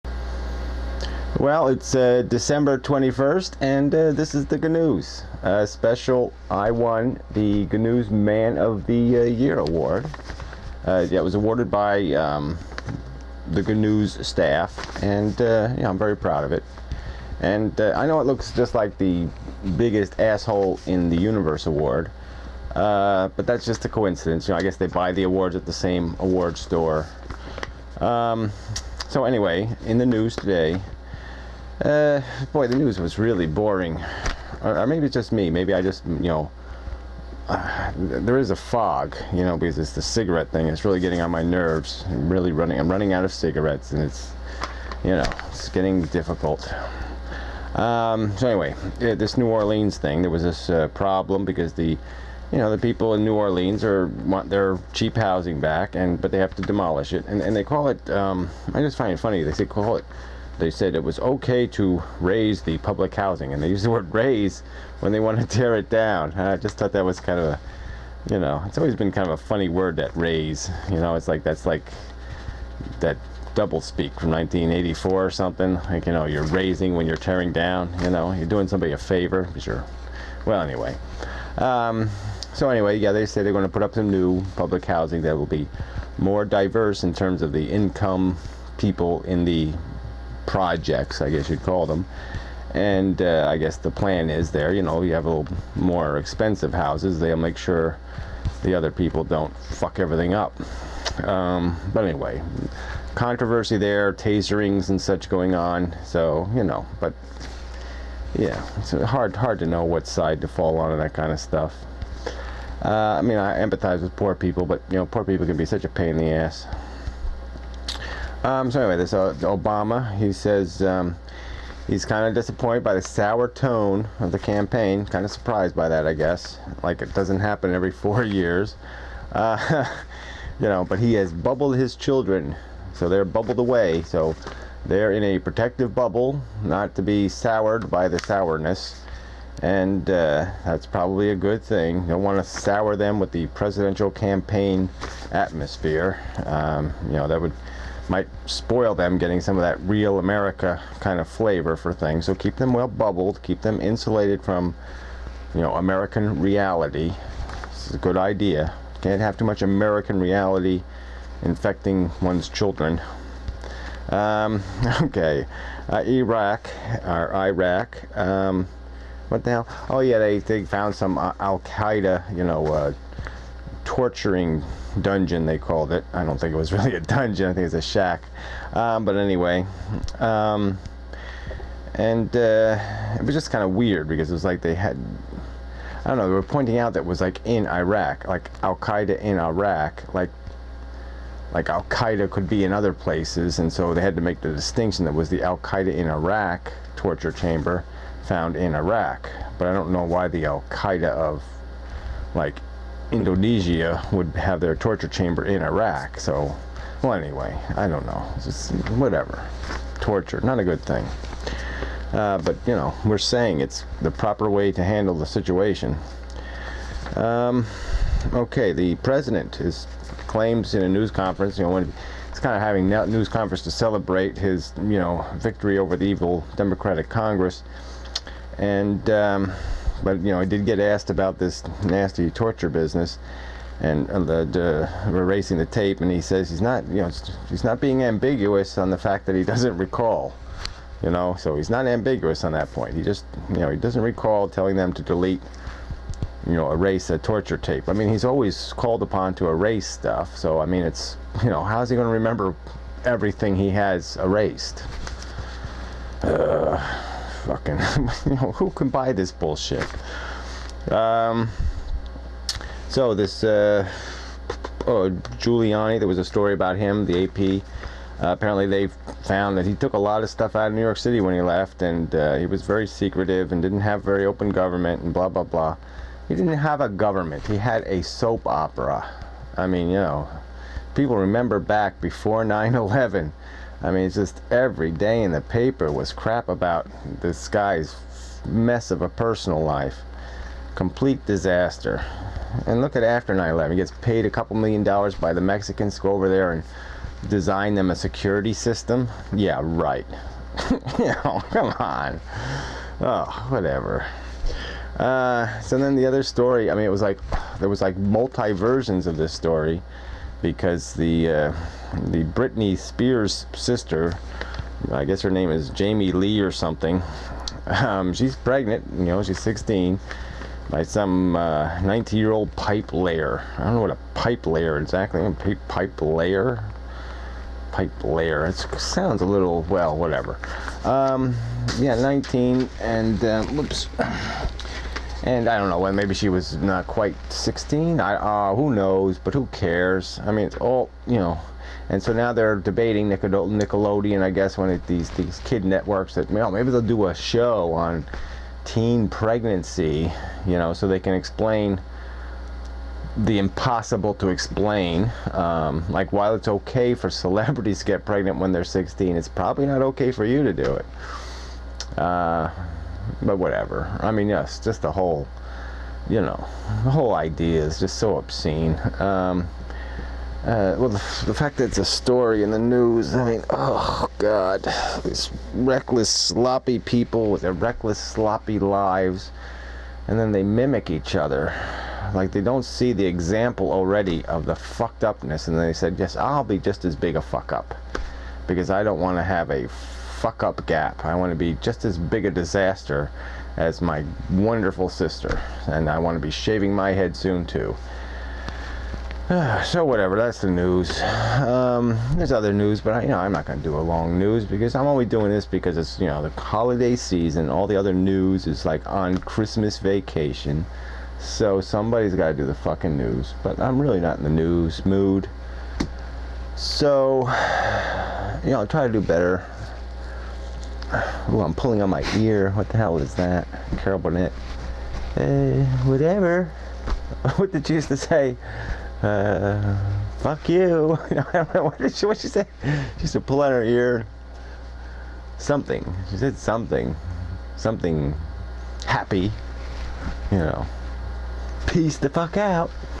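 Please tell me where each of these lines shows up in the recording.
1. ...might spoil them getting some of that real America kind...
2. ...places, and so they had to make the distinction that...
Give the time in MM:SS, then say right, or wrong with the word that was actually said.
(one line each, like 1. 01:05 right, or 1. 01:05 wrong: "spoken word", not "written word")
1. 02:28 right
2. 03:12 right.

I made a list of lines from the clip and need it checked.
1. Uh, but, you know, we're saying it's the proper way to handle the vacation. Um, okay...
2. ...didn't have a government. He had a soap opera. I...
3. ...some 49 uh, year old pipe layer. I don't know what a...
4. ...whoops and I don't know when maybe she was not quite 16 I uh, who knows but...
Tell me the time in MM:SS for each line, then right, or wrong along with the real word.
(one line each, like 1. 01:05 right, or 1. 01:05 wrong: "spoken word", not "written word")
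1. 03:32 wrong: "situation", not "vacation"
2. 04:36 right
3. 05:20 wrong: "19", not "49"
4. 05:33 right.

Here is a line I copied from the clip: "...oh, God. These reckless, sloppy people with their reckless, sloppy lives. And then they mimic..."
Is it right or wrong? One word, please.
right.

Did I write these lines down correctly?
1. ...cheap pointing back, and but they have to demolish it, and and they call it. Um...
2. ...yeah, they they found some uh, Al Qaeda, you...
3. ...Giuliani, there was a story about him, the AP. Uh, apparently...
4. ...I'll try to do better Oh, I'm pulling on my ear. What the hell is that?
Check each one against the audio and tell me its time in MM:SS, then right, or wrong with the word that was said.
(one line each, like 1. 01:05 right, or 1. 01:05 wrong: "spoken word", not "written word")
1. 00:54 wrong: "housing", not "pointing"
2. 02:50 right
3. 04:25 right
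4. 06:58 right.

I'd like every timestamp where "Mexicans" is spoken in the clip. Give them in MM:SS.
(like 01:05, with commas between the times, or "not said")
04:55.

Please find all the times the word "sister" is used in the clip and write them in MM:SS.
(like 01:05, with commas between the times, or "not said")
05:13, 06:34.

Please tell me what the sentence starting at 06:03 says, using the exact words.
I mean, yes, just the whole, you know, the whole idea is just so obscene.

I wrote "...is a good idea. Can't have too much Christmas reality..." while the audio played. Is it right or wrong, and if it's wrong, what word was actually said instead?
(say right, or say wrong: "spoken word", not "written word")
wrong: "American", not "Christmas".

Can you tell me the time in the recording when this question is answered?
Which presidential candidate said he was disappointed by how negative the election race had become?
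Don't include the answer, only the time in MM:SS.
01:59.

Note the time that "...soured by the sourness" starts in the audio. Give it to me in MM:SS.
02:17.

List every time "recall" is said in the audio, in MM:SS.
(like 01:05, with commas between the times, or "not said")
03:59, 04:04.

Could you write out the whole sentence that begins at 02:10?
But he has bubbled his children, so they're bubbled away.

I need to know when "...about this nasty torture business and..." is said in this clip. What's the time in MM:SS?
03:51.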